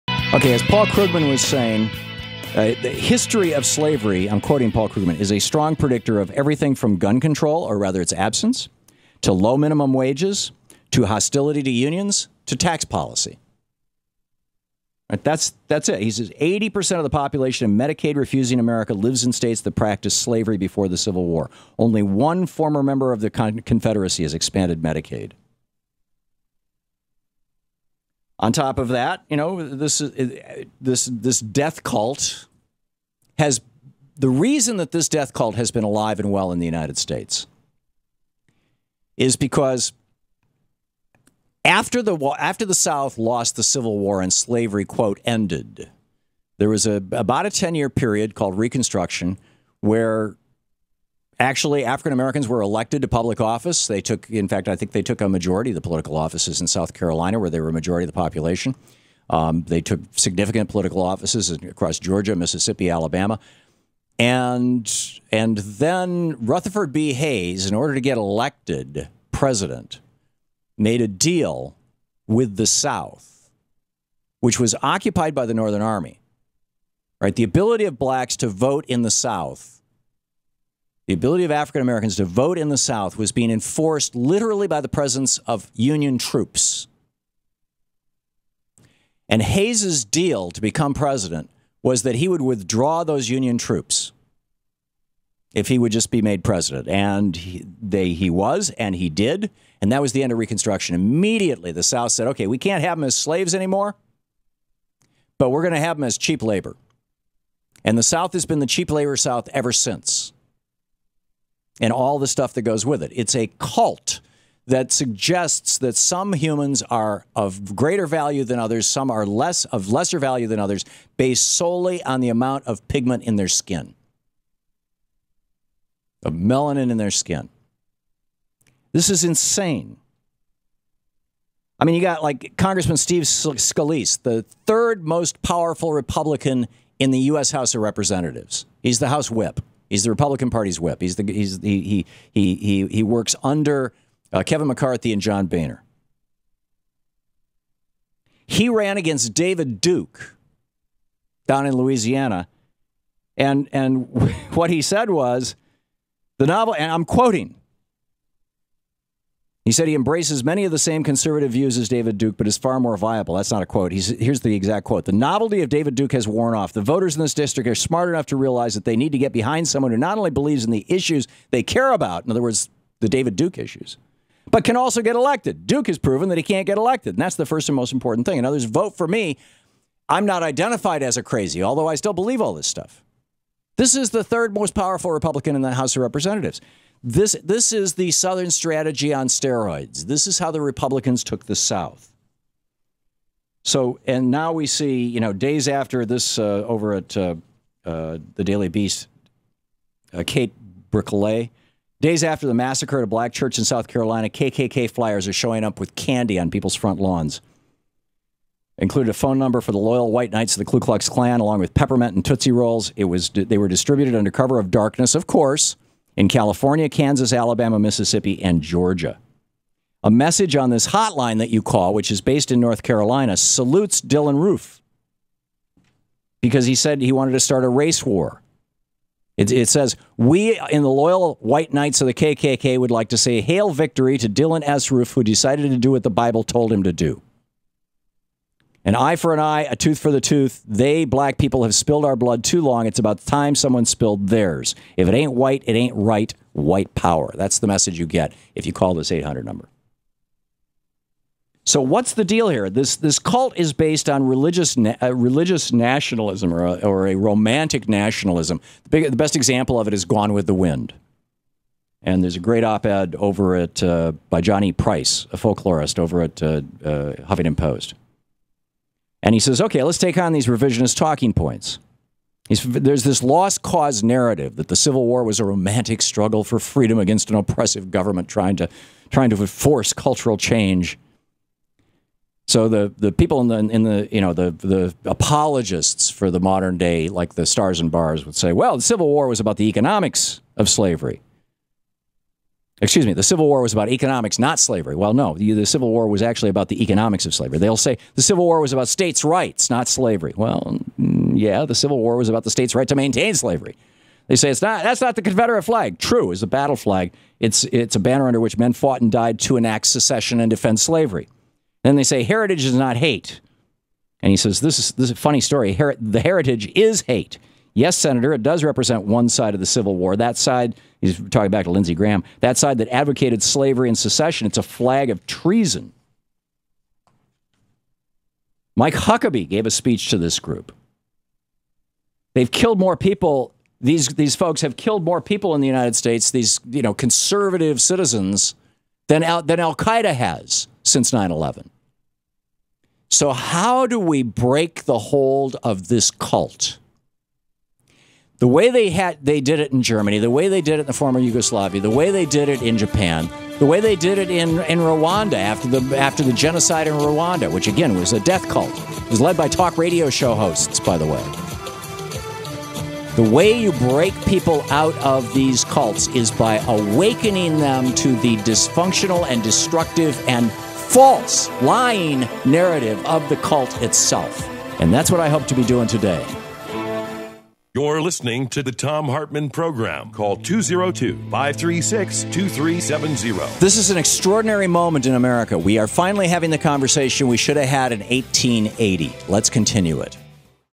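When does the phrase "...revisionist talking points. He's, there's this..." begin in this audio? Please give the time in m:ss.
4:30.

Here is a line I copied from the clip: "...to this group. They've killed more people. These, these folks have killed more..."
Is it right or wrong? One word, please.
right.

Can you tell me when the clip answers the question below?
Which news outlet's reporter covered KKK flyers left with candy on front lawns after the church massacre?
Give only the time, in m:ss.
3:18.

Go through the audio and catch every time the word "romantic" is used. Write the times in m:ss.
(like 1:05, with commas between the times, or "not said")
4:17, 4:35.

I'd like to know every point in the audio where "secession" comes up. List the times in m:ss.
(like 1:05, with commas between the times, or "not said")
5:09, 5:23.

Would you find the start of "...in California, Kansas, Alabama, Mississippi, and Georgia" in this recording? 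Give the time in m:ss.
3:36.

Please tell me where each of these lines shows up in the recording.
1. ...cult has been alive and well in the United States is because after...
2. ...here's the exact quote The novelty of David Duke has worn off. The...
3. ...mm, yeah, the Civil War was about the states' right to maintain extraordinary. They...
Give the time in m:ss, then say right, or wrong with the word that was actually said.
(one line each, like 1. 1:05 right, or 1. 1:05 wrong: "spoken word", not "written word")
1. 0:35 right
2. 2:44 right
3. 5:00 wrong: "slavery", not "extraordinary".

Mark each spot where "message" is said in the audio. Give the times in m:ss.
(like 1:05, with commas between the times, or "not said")
3:40, 4:07.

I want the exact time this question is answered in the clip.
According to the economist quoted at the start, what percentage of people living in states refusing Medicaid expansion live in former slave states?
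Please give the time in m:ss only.
0:16.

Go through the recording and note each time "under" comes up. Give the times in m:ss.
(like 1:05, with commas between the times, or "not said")
2:23, 3:34, 5:08.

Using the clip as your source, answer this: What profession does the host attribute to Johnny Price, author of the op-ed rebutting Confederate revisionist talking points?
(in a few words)
Folklorist.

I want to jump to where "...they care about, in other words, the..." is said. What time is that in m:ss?
2:51.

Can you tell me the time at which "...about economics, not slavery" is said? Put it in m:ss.
4:53.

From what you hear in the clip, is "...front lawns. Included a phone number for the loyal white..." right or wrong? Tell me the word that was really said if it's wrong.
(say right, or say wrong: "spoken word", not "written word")
right.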